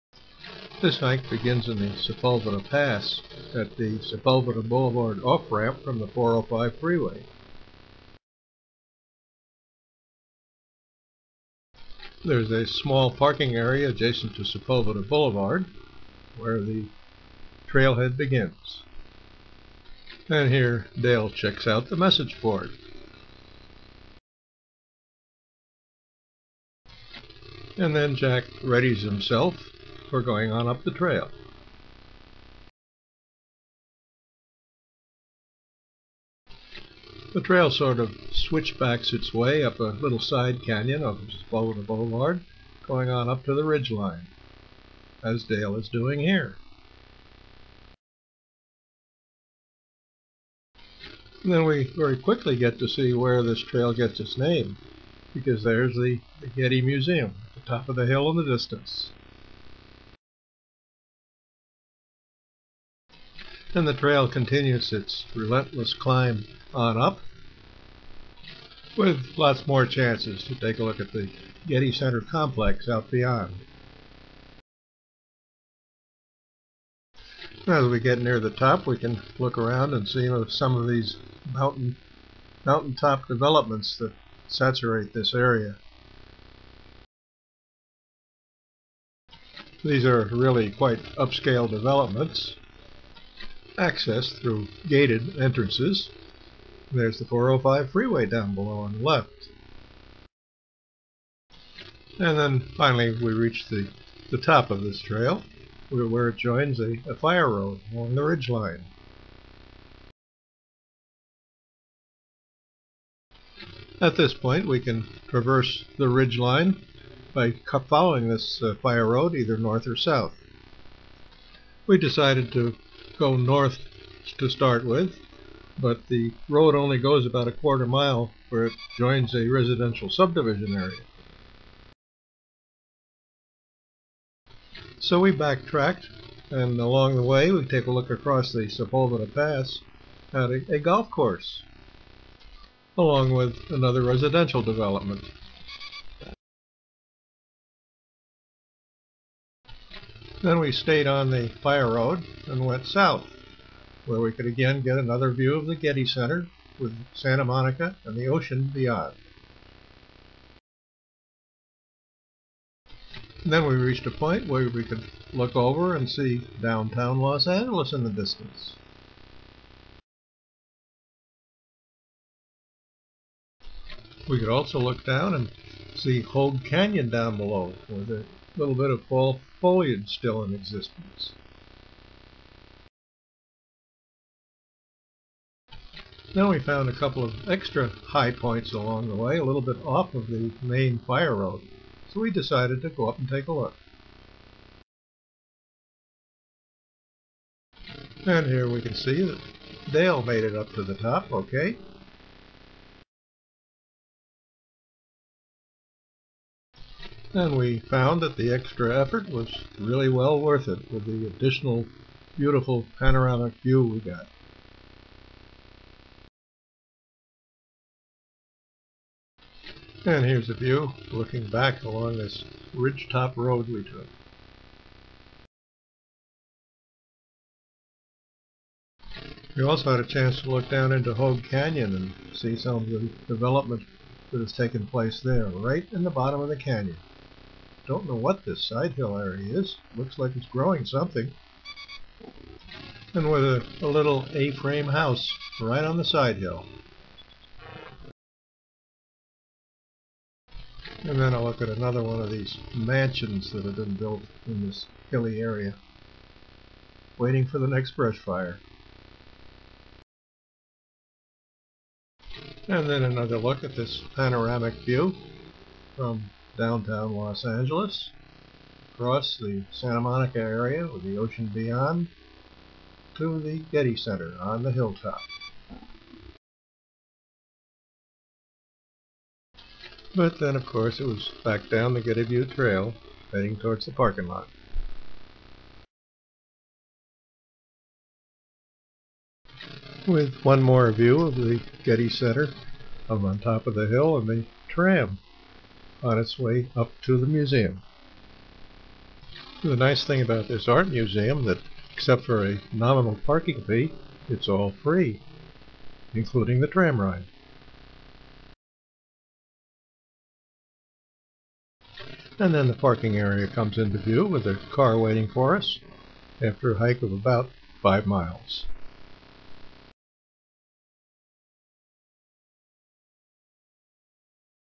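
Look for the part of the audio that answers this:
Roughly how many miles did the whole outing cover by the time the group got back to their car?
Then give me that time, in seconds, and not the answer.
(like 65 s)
317 s.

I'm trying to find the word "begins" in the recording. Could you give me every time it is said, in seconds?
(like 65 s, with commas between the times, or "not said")
1 s, 18 s.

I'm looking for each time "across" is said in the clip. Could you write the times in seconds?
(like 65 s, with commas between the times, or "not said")
138 s, 268 s.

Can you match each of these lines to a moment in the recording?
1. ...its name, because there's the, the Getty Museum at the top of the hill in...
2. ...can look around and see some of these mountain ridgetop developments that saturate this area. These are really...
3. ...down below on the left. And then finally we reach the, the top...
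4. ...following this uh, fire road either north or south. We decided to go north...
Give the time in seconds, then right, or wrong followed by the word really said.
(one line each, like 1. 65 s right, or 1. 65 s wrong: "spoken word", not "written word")
1. 54 s right
2. 78 s wrong: "mountaintop", not "ridgetop"
3. 98 s right
4. 117 s right.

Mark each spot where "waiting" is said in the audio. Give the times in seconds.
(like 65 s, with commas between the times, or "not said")
257 s, 314 s.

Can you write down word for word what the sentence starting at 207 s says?
And we found that the extra effort was really well worth it with the additional beautiful panoramic view we got.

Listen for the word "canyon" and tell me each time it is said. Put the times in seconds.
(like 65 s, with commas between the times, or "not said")
40 s, 176 s, 231 s, 236 s.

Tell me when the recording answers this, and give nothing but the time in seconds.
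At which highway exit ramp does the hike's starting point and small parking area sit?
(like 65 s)
3 s.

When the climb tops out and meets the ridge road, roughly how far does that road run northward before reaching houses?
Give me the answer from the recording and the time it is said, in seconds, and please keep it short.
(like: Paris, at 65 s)
a quarter mile, at 127 s.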